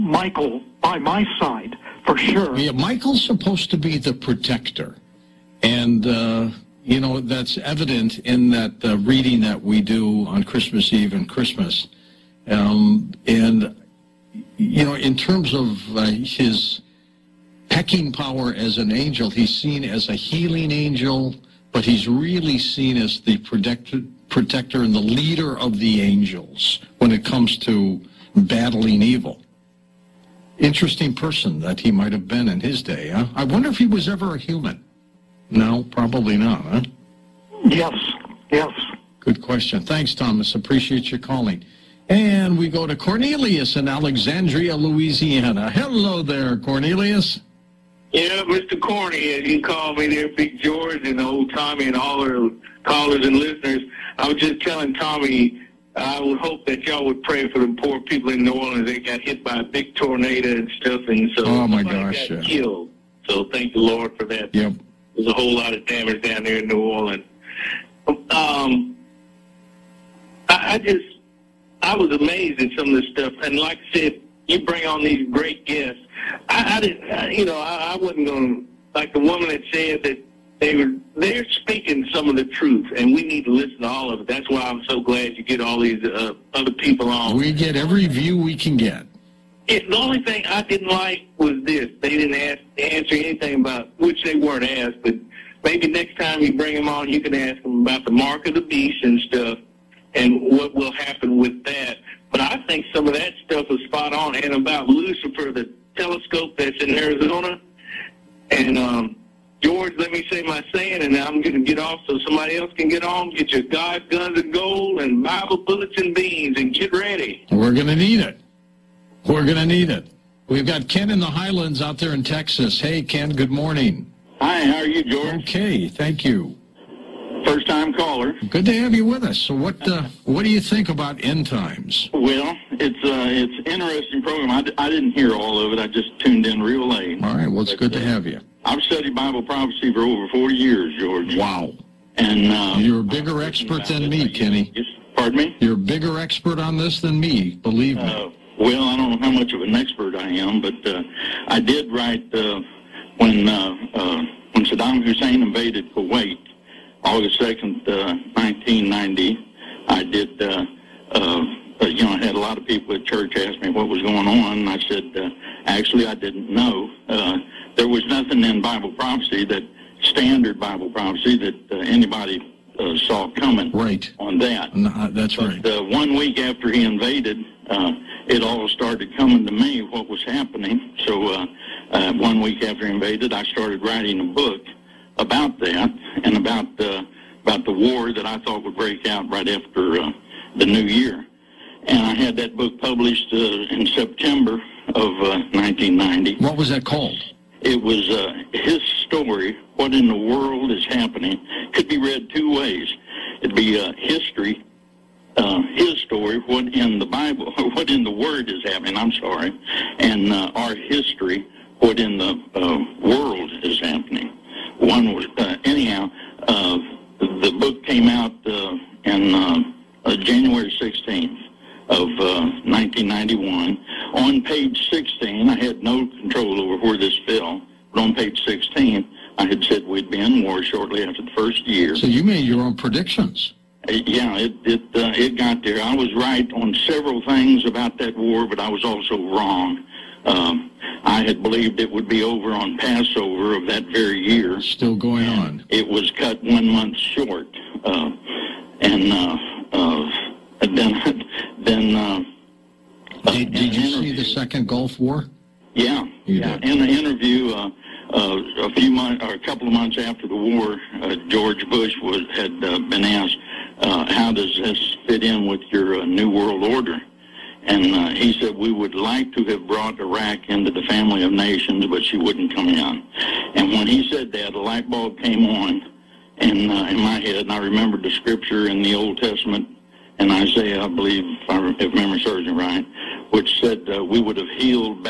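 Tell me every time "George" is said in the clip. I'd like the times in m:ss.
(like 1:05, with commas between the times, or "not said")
0:50, 1:49, 2:05, 2:20, 4:21.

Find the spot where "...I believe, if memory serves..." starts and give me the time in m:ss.
4:40.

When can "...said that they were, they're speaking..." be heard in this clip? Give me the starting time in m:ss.
1:19.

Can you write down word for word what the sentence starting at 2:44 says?
I said, uh, actually, I didn't know.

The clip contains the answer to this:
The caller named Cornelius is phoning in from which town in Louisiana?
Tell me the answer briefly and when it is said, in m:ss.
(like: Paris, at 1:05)
Alexandria, at 0:43.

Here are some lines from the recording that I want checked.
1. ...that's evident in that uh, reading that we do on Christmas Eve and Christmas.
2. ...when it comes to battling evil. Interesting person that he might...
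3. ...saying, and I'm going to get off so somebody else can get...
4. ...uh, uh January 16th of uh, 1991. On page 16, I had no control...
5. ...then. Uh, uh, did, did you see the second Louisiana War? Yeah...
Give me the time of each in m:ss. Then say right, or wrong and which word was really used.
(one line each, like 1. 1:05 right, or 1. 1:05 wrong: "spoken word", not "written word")
1. 0:07 right
2. 0:26 right
3. 1:50 right
4. 3:39 right
5. 4:11 wrong: "Gulf", not "Louisiana".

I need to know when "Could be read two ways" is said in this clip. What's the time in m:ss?
3:21.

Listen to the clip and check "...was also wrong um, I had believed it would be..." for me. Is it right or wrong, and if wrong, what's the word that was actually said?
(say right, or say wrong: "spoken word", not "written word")
right.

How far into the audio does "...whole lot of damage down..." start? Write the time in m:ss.
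1:05.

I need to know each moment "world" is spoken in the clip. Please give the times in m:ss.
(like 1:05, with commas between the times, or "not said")
3:20, 3:33, 4:26.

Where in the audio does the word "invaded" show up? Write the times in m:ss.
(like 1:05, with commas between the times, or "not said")
2:35, 2:56, 3:02.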